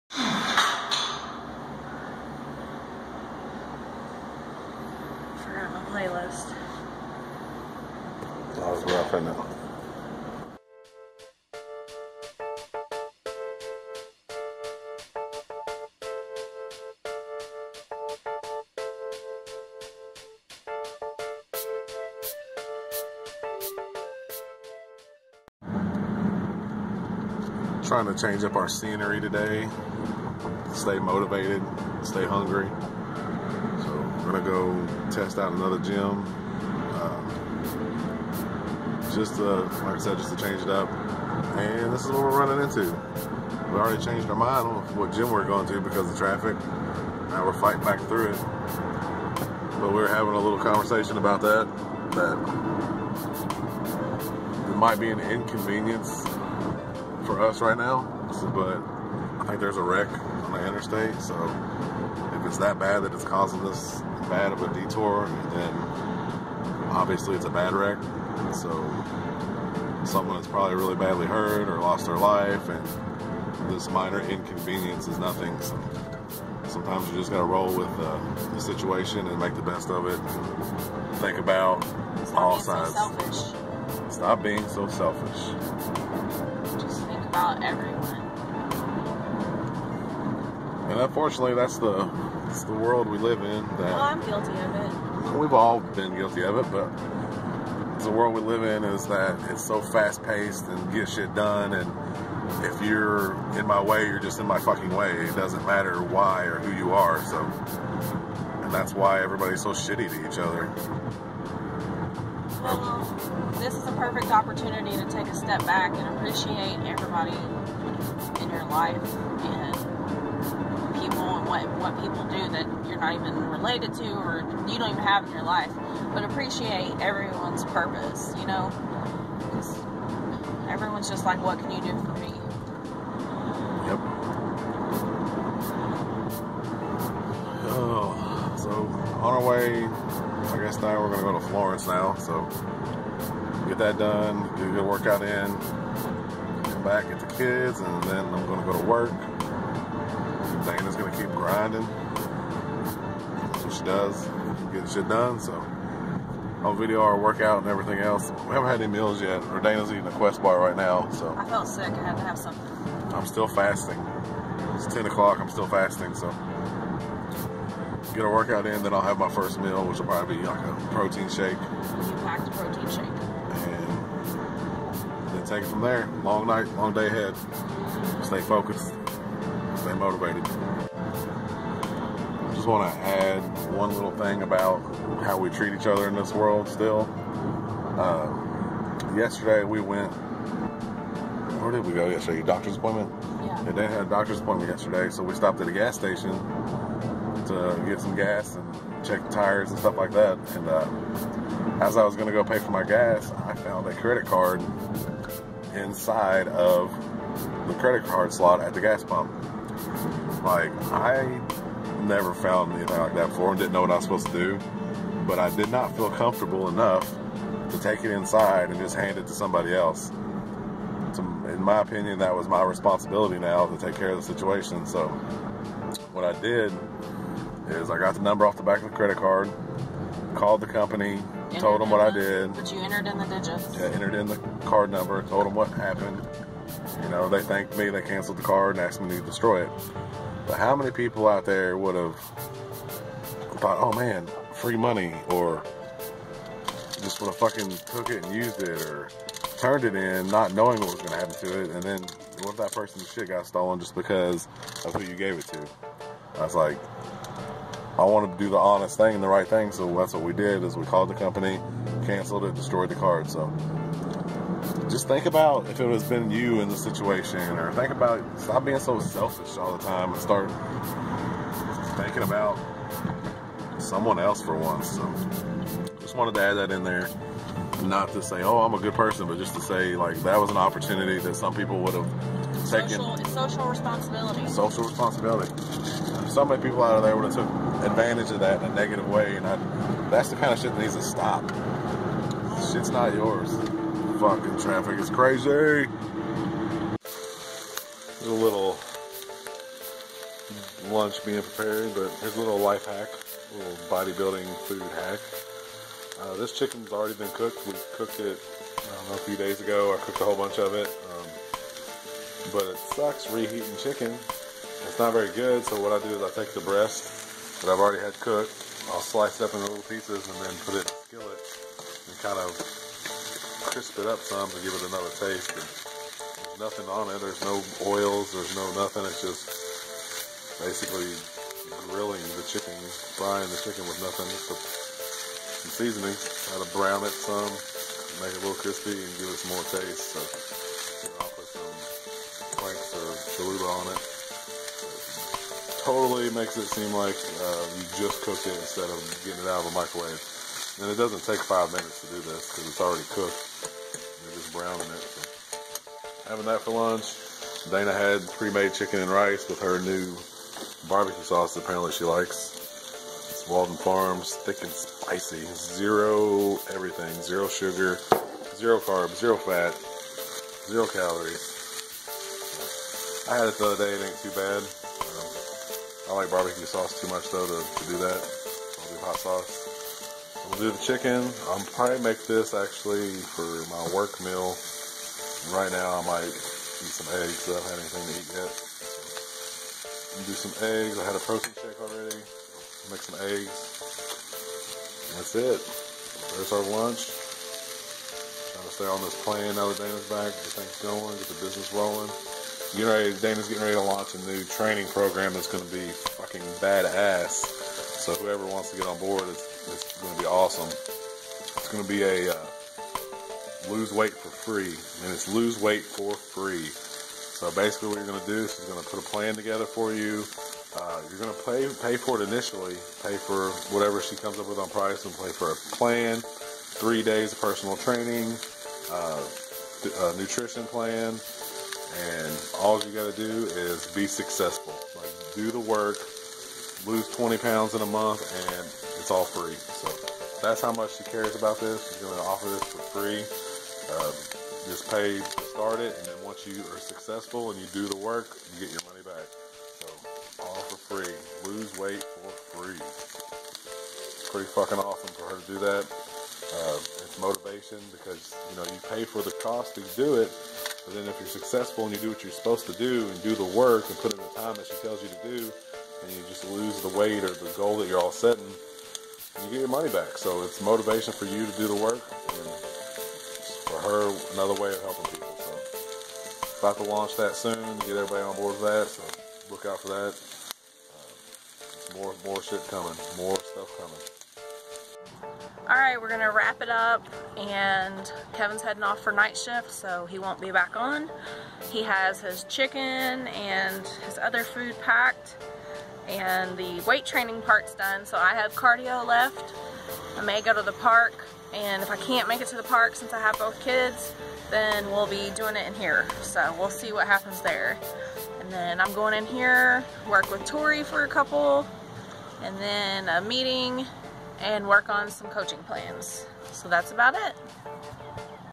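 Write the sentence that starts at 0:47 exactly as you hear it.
Now we're fighting back through it.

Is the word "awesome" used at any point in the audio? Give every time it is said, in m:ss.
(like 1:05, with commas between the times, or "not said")
6:50, 7:34.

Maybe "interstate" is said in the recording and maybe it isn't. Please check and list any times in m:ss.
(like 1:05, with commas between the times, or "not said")
1:00.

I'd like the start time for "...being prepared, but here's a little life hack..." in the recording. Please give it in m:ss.
5:01.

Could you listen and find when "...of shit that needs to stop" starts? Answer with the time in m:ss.
4:50.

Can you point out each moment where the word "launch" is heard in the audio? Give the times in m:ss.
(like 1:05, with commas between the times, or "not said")
6:43, 7:56.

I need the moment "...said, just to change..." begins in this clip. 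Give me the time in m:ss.
0:39.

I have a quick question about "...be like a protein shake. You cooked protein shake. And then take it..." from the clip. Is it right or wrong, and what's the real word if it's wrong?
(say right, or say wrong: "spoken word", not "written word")
wrong: "packed", not "cooked".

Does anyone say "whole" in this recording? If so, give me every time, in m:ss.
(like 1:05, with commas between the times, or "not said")
5:10.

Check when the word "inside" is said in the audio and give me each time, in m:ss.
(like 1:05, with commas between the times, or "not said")
3:25, 3:38.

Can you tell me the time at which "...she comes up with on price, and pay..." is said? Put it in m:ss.
7:04.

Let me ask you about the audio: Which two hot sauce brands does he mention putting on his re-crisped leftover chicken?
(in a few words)
Franks or Cholula.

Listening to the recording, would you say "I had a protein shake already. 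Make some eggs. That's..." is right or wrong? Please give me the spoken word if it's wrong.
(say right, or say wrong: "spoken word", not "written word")
right.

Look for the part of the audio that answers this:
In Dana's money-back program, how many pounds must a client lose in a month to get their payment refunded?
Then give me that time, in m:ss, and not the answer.
7:17.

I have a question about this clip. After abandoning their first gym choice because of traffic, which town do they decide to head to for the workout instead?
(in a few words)
Florence.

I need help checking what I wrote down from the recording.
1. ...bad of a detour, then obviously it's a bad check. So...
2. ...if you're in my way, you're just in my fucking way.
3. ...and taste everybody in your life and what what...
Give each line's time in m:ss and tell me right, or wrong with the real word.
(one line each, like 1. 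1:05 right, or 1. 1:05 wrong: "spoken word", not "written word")
1. 1:04 wrong: "wreck", not "check"
2. 1:42 right
3. 1:55 wrong: "appreciate", not "taste".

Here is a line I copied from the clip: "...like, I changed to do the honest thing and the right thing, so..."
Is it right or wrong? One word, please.
wrong.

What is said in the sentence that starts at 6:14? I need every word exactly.
Um, I like barbecue sauce too much though to, to do that.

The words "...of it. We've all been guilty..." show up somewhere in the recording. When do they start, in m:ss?
1:34.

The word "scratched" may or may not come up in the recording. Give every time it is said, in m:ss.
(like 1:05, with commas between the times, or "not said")
not said.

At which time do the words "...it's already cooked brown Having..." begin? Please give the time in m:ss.
5:52.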